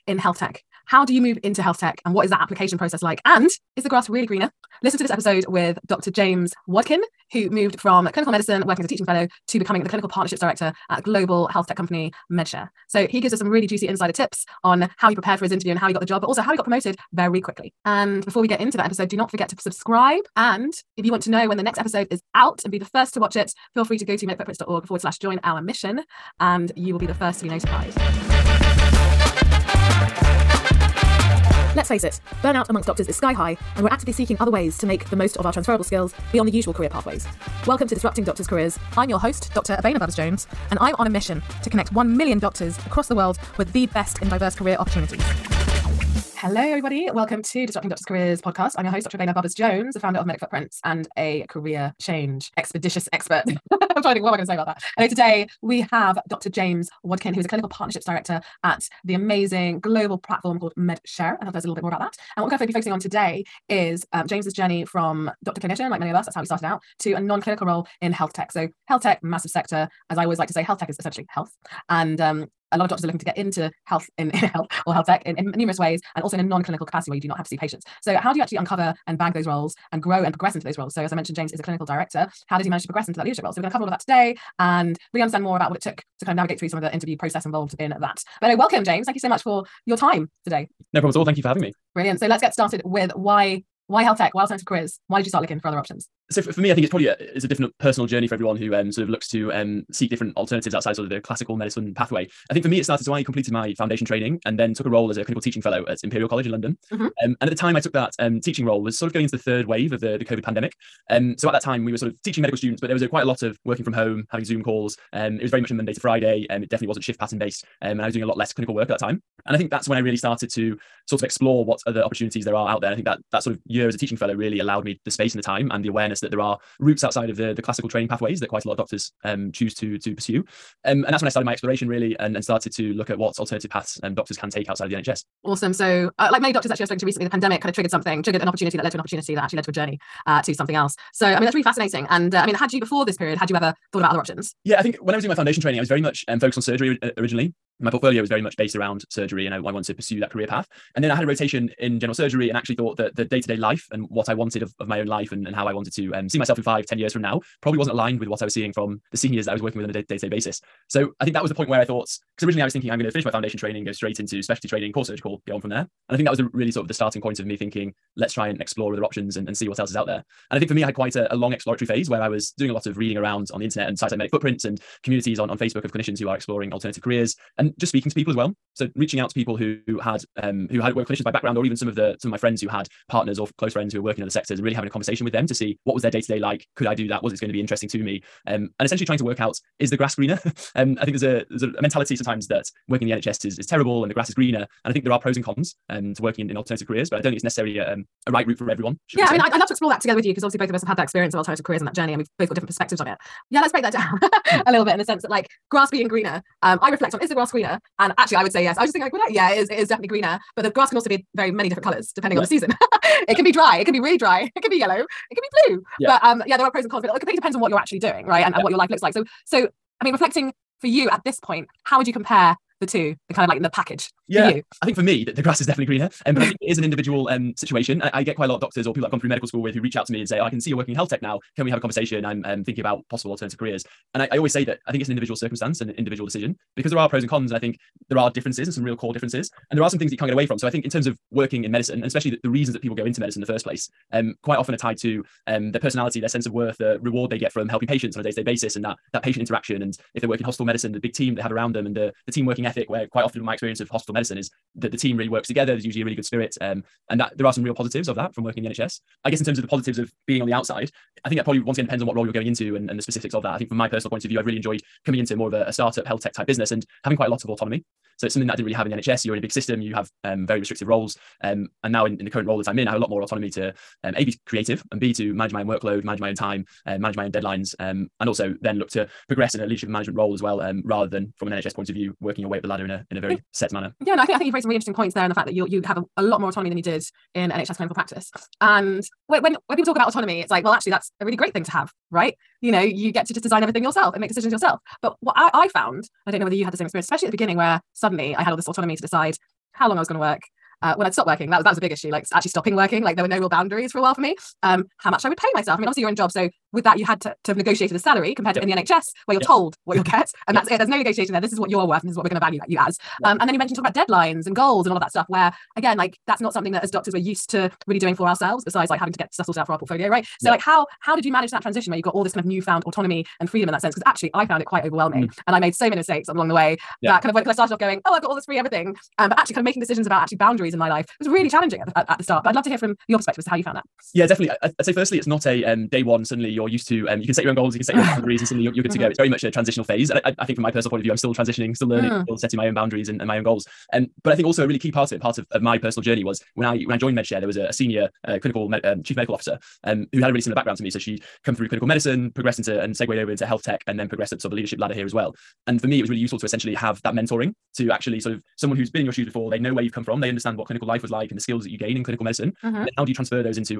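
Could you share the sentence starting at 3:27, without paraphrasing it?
And actually, I would say yes.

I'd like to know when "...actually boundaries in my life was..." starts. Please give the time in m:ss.
5:30.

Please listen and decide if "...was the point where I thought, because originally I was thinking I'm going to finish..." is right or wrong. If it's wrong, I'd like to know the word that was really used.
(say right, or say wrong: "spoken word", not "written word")
right.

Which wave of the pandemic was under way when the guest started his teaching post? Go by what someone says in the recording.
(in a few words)
Third wave.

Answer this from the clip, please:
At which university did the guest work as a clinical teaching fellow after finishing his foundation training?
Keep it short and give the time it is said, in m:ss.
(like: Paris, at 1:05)
Imperial College, at 1:46.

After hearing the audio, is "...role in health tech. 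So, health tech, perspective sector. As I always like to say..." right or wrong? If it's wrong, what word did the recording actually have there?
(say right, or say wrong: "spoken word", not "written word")
wrong: "massive", not "perspective".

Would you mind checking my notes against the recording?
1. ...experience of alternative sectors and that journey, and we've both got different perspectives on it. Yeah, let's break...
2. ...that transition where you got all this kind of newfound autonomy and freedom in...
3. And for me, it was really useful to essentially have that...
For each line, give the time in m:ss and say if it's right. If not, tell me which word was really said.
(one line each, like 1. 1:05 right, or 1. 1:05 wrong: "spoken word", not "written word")
1. 3:21 wrong: "careers", not "sectors"
2. 5:21 right
3. 5:55 right.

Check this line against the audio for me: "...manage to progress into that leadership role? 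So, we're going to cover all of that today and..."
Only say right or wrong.
right.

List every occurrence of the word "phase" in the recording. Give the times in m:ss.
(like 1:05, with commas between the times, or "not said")
2:51, 5:39.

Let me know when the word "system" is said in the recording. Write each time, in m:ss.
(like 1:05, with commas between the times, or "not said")
4:29.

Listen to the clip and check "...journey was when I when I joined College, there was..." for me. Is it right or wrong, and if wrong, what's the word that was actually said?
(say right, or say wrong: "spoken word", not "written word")
wrong: "MedShr", not "College".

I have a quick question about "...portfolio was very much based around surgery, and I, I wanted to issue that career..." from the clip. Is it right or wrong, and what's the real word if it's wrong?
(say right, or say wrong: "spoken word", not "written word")
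wrong: "pursue", not "issue".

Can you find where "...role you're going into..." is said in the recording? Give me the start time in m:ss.
4:22.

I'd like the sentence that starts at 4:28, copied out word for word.
So it's something that I didn't really have in the NHS.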